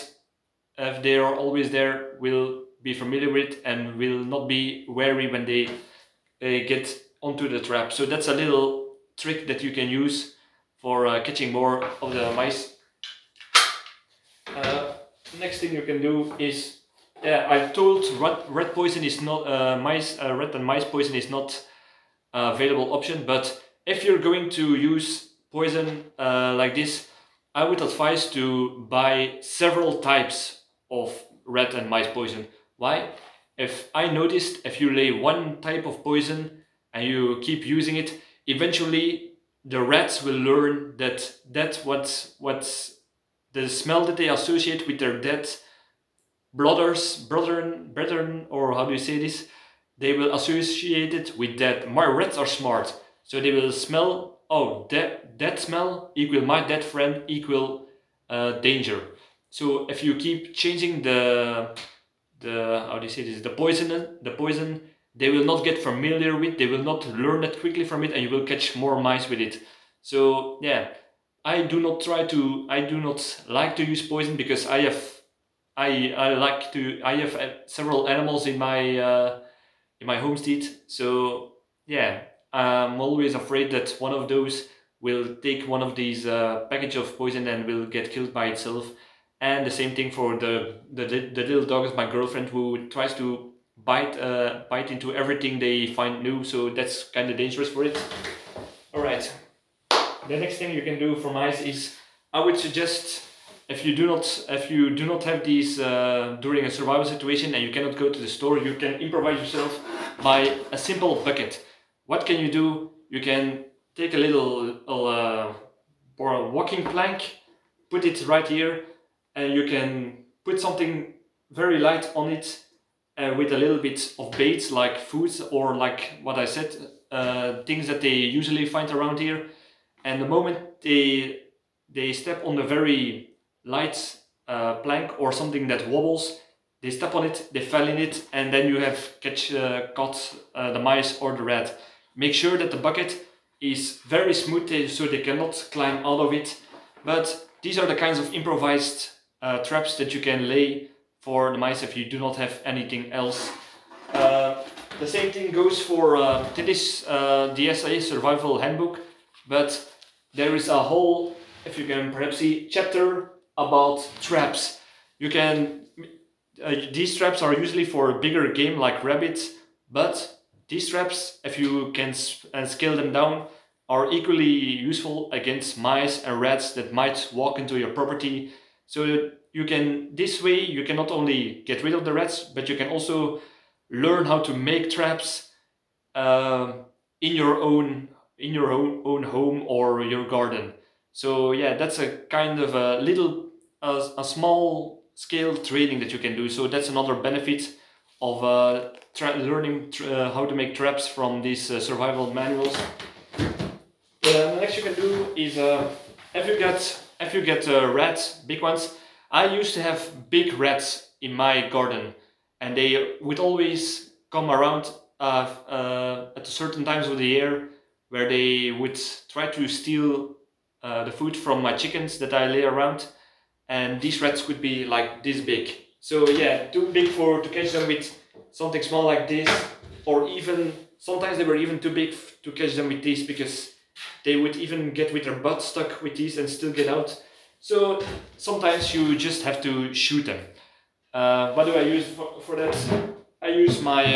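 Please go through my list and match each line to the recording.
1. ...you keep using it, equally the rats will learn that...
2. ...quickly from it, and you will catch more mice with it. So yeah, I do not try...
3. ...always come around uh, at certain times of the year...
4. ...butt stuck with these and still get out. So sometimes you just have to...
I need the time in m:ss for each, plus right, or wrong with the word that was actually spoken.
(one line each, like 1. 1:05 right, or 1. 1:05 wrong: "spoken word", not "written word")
1. 0:37 wrong: "eventually", not "equally"
2. 1:07 right
3. 3:33 right
4. 3:55 right.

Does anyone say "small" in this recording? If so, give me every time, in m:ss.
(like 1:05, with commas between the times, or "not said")
3:14, 3:48.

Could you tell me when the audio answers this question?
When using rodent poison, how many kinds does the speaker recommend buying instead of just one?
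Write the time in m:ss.
0:29.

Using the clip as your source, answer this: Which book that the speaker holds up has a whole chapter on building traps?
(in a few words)
The Survival Handbook.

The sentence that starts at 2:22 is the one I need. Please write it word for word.
Make sure that the bucket is very smooth uh, so they cannot climb out of it.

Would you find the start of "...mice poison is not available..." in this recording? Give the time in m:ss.
0:20.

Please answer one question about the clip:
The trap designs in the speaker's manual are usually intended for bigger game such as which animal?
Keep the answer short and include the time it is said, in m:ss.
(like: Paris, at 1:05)
Rabbits, at 2:49.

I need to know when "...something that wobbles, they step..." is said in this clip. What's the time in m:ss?
2:15.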